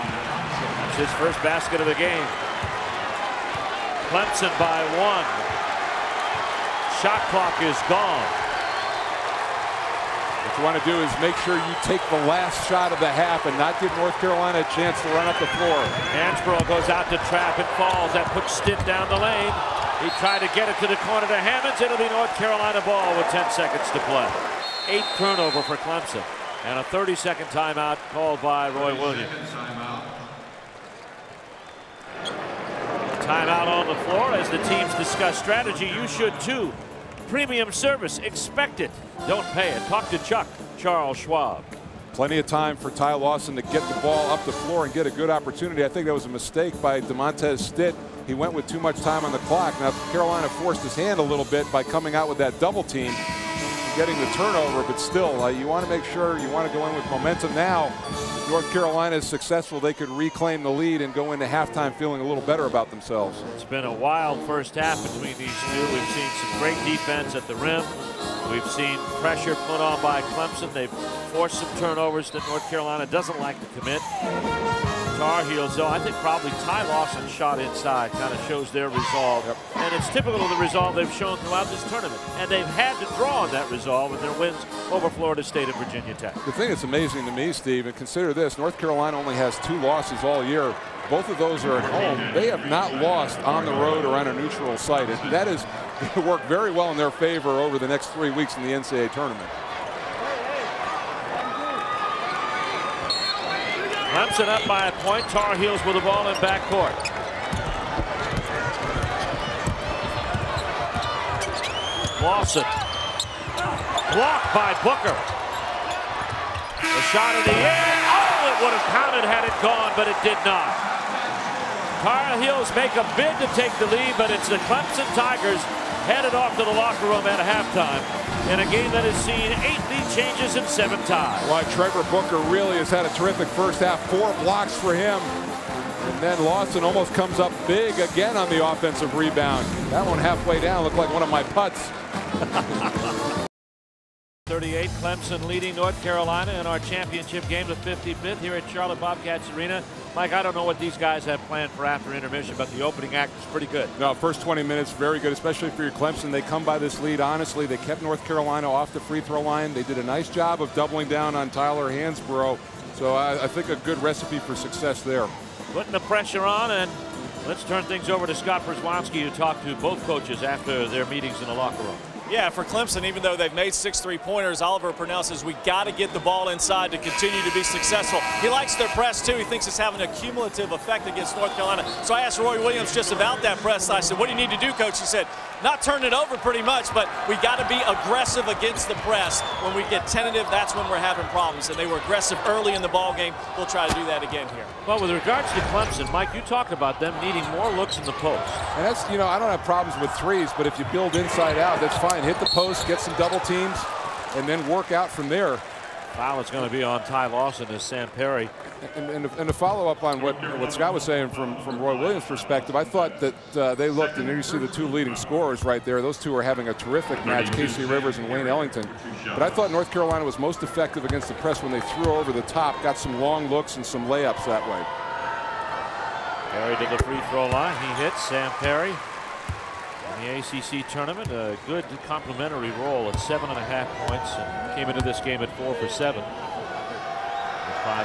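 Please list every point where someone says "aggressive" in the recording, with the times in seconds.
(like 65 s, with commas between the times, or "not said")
187 s, 191 s.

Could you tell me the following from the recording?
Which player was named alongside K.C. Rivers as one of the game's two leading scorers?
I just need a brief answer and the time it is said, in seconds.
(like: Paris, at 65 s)
Wayne Ellington, at 218 s.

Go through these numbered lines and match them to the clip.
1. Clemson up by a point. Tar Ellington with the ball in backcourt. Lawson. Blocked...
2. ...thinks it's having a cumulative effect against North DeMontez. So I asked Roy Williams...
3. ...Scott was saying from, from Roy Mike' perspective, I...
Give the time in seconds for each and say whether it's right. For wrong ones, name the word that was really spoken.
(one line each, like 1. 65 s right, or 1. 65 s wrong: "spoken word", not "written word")
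1. 104 s wrong: "Heels", not "Ellington"
2. 179 s wrong: "Carolina", not "DeMontez"
3. 210 s wrong: "Williams", not "Mike".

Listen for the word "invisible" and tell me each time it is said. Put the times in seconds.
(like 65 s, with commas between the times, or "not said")
not said.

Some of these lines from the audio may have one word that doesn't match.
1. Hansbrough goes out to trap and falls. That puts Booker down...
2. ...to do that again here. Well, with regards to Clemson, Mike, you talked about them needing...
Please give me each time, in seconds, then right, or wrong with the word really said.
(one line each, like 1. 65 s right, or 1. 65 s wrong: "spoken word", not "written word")
1. 16 s wrong: "Stitt", not "Booker"
2. 193 s right.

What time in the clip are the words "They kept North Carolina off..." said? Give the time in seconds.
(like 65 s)
157 s.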